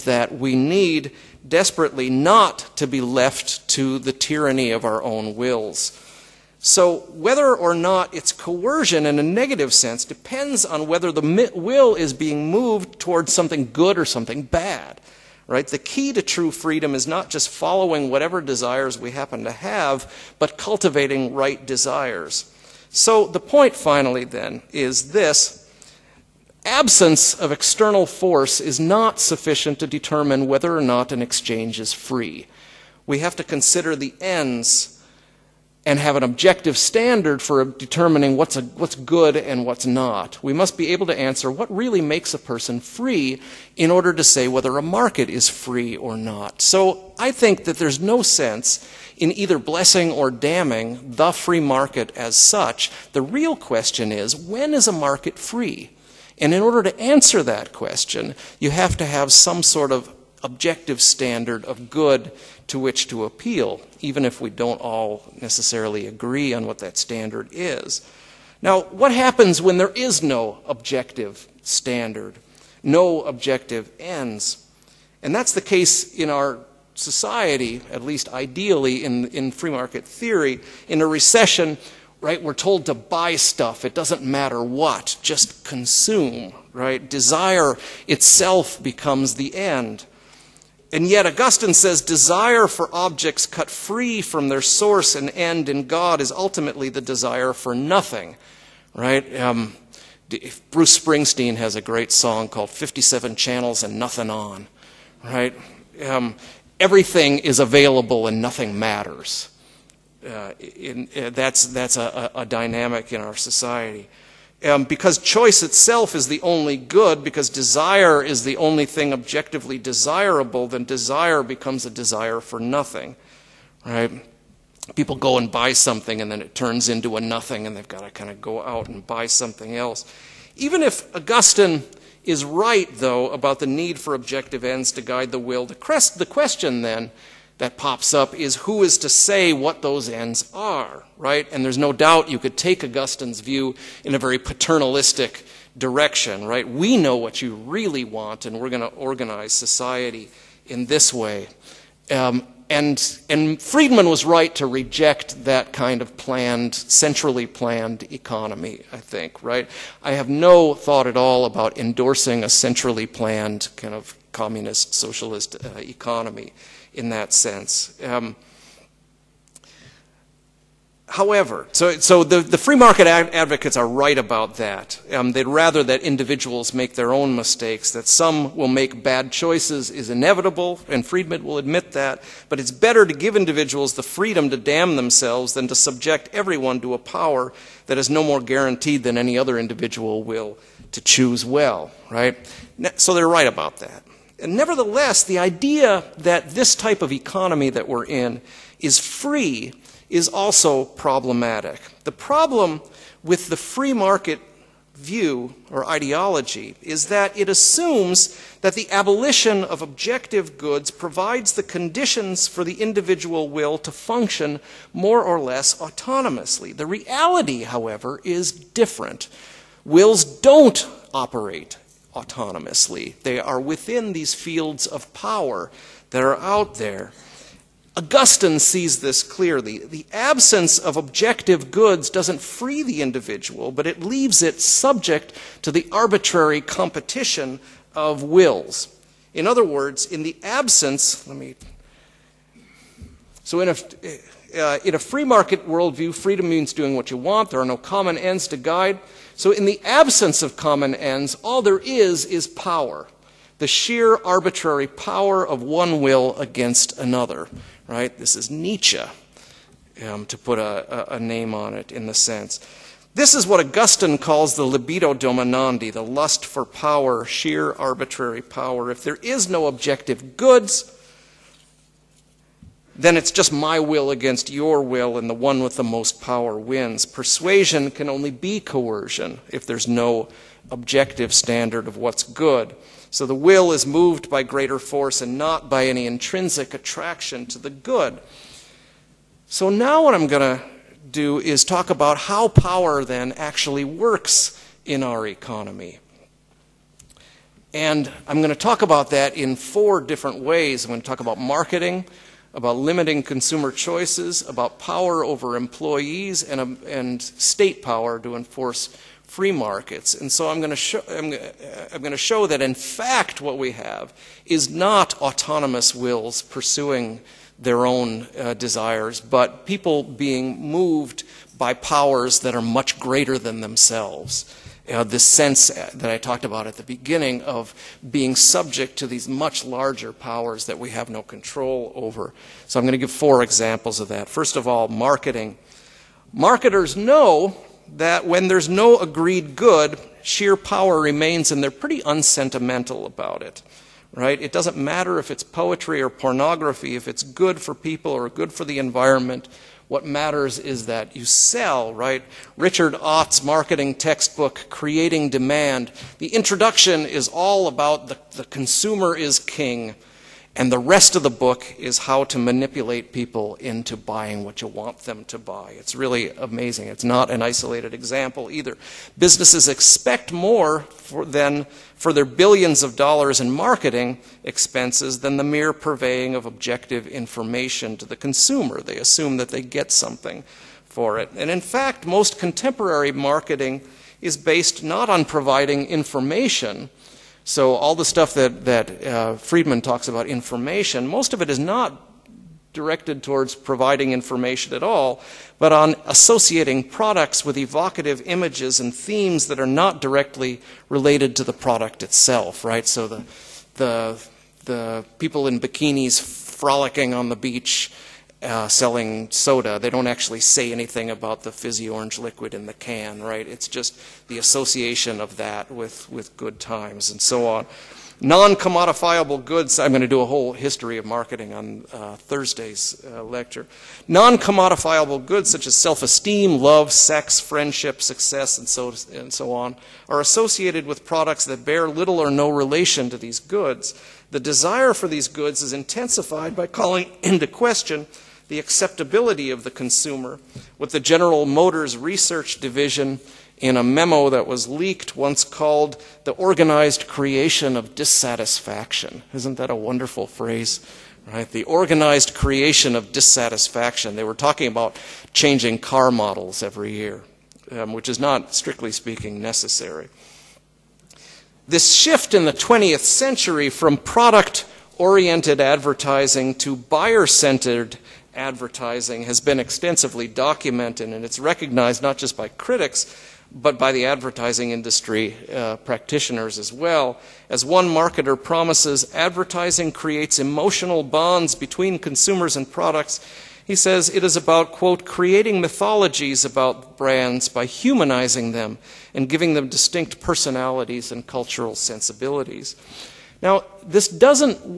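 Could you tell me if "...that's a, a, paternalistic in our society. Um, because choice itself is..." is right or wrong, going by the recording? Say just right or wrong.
wrong.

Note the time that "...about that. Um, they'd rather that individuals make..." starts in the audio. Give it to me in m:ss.
2:54.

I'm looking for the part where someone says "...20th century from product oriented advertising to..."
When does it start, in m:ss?
7:42.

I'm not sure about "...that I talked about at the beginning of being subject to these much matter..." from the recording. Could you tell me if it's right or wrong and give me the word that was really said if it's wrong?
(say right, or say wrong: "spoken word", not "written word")
wrong: "larger", not "matter".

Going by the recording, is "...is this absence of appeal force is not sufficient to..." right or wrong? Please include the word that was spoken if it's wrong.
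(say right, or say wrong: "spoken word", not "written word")
wrong: "external", not "appeal".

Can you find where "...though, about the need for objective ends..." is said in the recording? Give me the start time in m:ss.
2:12.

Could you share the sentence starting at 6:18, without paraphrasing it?
They assume that they get something for it.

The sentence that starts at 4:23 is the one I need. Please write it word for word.
This is what Augustine calls the libido dominandi, the lust for power, sheer arbitrary power.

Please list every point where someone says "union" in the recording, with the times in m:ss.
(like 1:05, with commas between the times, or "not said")
not said.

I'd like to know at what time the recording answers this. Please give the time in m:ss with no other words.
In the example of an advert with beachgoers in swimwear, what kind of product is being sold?
6:49.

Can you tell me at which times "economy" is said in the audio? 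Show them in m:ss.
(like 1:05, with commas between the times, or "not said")
2:38, 2:45, 3:17, 4:55.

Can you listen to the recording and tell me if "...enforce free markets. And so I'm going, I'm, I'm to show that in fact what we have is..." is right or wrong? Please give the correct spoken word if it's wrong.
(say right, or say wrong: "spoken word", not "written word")
right.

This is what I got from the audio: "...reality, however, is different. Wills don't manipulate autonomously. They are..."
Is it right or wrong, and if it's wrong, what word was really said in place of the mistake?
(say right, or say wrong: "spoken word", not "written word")
wrong: "operate", not "manipulate".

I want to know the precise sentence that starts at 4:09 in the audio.
So, in the absence of common ends, all there is is power the sheer arbitrary power of one will against another, right?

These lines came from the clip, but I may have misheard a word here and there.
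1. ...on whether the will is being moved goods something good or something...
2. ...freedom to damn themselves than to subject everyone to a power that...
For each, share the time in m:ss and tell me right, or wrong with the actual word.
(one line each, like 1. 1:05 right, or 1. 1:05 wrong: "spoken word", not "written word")
1. 0:10 wrong: "towards", not "goods"
2. 3:04 right.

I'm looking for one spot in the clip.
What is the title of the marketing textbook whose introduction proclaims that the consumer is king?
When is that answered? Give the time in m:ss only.
5:54.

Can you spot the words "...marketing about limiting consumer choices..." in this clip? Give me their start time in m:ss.
5:01.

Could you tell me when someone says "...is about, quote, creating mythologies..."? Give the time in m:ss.
8:04.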